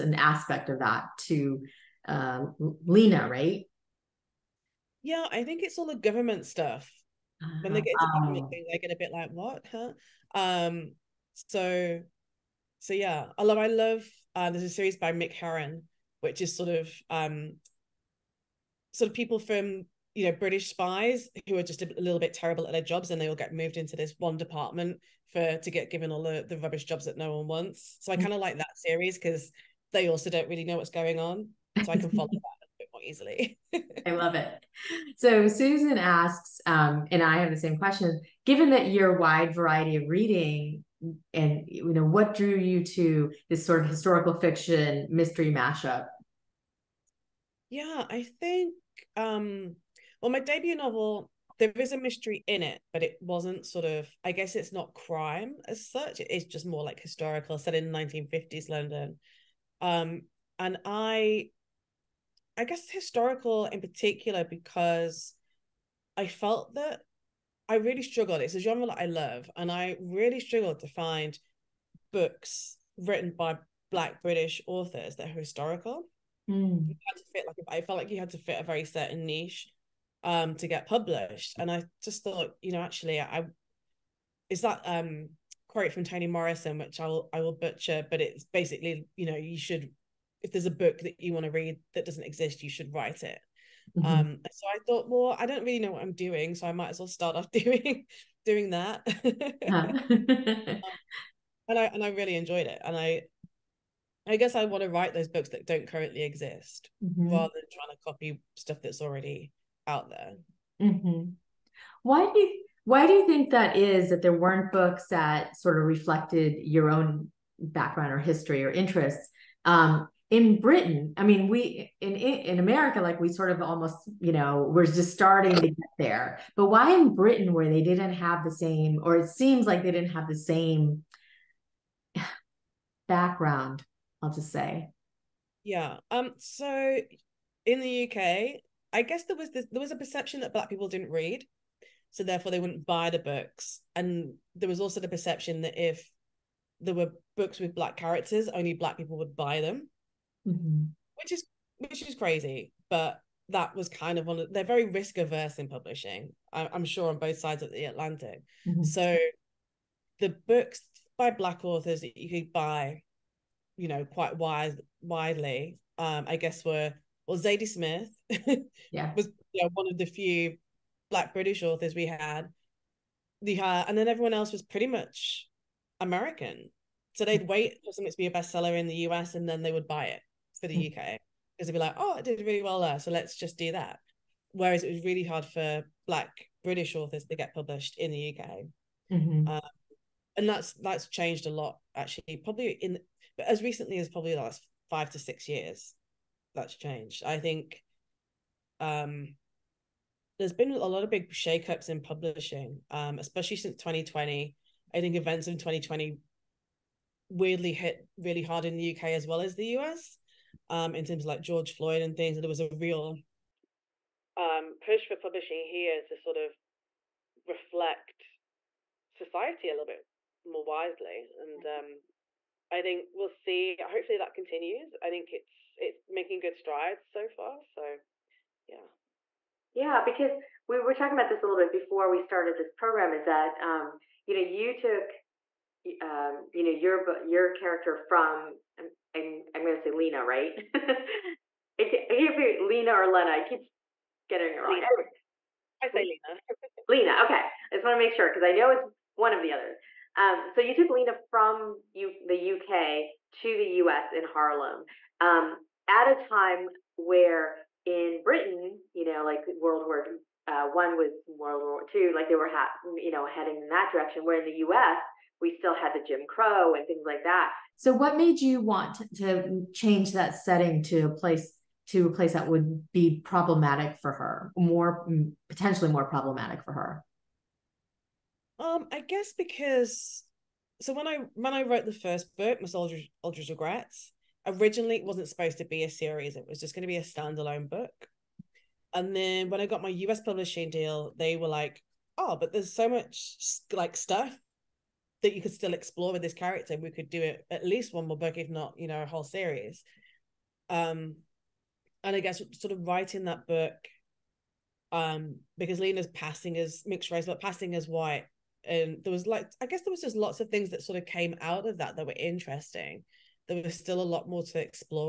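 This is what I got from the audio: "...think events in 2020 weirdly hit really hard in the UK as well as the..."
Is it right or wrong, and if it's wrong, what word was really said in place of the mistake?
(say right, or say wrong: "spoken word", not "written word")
right.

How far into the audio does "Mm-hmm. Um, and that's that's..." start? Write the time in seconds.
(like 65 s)
189 s.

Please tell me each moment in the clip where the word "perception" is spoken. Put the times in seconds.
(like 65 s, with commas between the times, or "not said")
139 s, 145 s.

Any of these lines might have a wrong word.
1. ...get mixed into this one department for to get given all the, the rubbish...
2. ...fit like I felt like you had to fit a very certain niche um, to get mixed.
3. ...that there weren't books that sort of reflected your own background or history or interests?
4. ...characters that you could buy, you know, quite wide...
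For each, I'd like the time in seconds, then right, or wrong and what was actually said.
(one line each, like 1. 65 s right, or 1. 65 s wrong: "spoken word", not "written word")
1. 23 s wrong: "moved", not "mixed"
2. 77 s wrong: "published", not "mixed"
3. 114 s right
4. 161 s wrong: "authors", not "characters".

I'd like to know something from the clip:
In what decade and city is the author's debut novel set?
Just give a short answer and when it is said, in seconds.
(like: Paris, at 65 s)
1950s London, at 57 s.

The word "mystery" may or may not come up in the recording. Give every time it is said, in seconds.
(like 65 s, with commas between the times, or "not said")
45 s, 51 s.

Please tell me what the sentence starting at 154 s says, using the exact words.
Of, they're very risk averse in publishing.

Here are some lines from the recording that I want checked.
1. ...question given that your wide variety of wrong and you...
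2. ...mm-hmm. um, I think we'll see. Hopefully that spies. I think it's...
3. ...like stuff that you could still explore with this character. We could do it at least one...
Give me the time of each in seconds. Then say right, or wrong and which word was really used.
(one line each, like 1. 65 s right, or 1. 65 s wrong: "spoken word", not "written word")
1. 37 s wrong: "reading", not "wrong"
2. 221 s wrong: "continues", not "spies"
3. 293 s right.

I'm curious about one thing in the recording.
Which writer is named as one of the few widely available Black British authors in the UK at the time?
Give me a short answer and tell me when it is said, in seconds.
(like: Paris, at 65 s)
Zadie Smith, at 167 s.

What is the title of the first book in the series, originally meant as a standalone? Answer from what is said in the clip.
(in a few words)
Miss Aldridge Regrets.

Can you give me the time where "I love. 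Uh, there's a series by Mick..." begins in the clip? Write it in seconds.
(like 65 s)
13 s.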